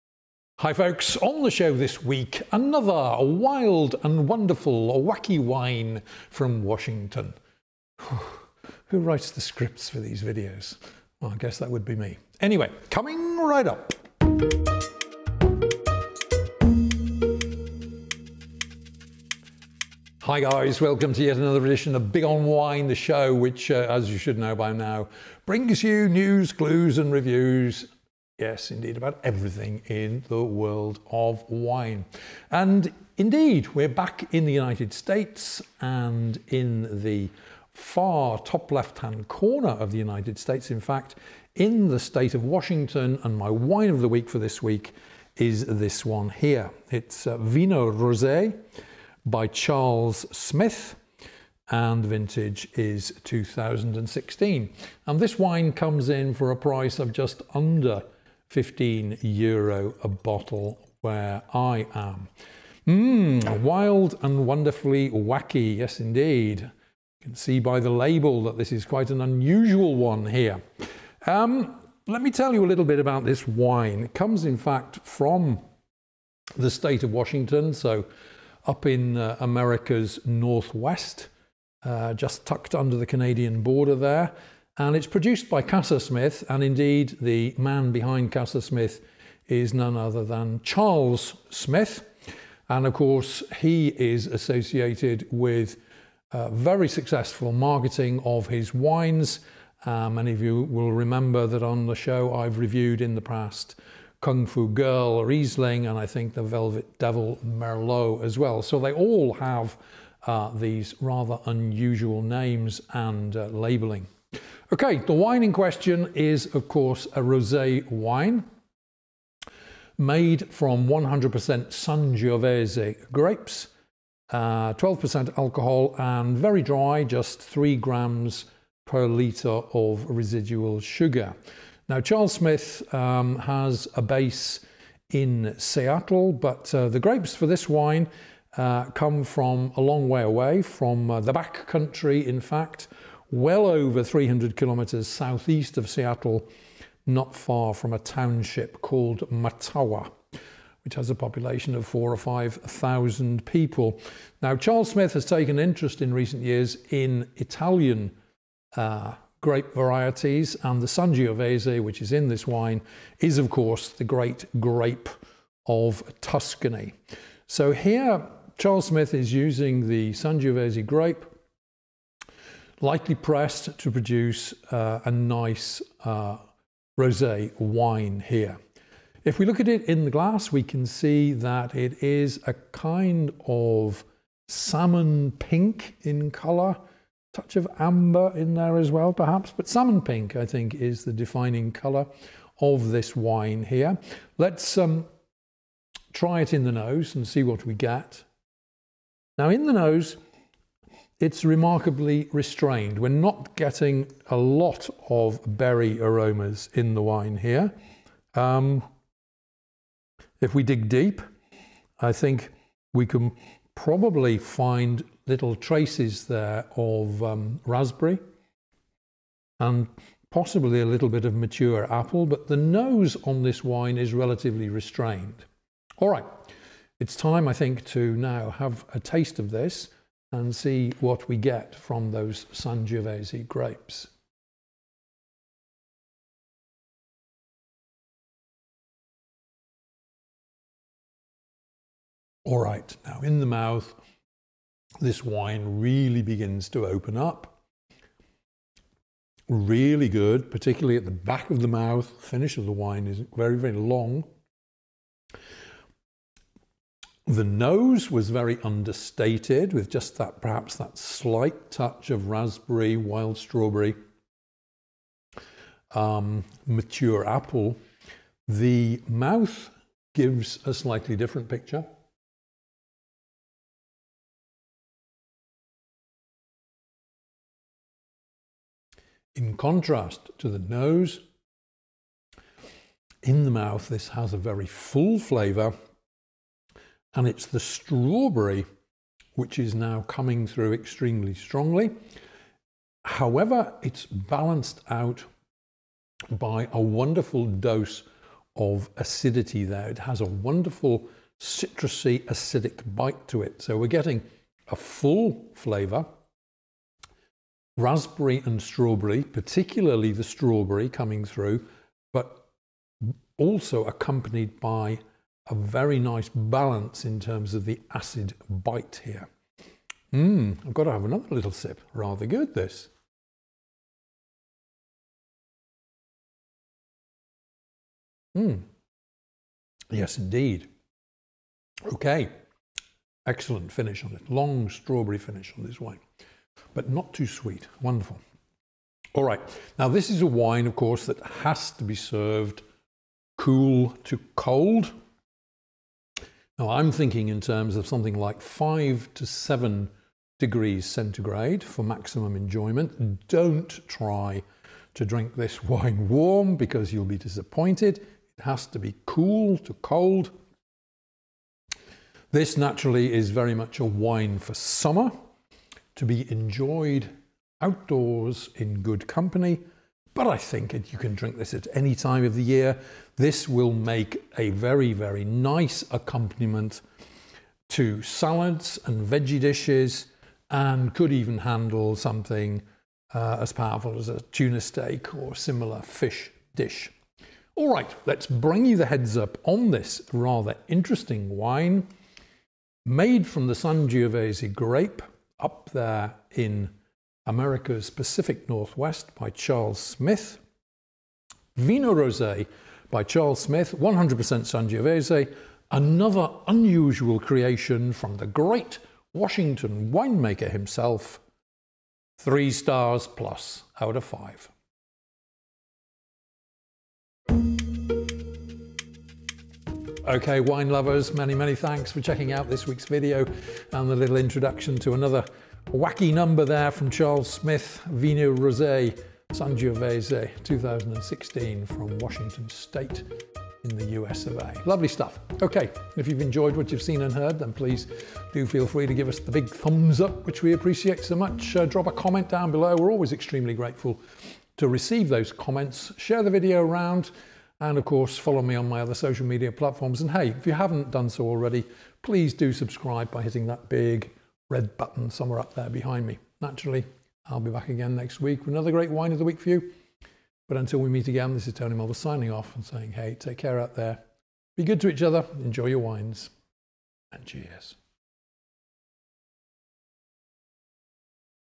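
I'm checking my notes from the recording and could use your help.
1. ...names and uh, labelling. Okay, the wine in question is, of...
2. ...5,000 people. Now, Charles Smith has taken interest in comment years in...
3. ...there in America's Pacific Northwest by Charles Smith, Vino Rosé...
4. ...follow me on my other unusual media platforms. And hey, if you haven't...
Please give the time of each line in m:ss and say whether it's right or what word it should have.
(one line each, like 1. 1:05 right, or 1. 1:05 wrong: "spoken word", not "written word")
1. 1:52 right
2. 2:32 wrong: "recent", not "comment"
3. 6:35 right
4. 7:28 wrong: "social", not "unusual".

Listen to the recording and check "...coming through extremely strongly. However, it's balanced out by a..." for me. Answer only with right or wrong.
right.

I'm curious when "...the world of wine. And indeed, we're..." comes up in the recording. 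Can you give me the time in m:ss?
0:30.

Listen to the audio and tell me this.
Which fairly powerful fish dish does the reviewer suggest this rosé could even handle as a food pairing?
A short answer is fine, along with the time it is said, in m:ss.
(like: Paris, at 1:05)
tuna steak, at 6:24.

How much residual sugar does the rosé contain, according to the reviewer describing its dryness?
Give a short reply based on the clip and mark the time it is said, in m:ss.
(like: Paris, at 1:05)
3 grams per litre, at 2:07.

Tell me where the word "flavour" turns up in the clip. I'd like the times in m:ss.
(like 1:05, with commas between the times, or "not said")
4:45, 5:05.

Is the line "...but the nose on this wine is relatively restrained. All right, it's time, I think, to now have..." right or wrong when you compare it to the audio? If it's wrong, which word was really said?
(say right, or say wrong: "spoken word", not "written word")
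right.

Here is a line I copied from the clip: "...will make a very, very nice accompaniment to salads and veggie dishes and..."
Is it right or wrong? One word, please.
right.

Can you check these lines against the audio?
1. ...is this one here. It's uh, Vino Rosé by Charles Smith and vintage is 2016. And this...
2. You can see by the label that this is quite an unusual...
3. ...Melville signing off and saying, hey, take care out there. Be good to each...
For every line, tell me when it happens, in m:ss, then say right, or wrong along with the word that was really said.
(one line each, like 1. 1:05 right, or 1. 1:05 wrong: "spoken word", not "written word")
1. 0:45 right
2. 1:06 right
3. 7:41 right.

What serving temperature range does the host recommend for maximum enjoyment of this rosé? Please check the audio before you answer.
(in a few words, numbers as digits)
5 to 7 degrees centigrade.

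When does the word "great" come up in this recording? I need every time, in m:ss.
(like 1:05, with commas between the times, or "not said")
2:44, 6:48, 7:38.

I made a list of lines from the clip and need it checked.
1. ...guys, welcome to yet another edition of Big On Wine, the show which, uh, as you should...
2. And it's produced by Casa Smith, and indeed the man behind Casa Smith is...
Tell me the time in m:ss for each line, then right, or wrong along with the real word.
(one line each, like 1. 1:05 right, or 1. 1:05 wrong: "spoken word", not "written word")
1. 0:20 right
2. 1:24 right.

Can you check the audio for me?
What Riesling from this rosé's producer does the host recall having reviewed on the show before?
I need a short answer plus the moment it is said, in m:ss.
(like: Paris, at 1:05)
Kung Fu Girl, at 1:44.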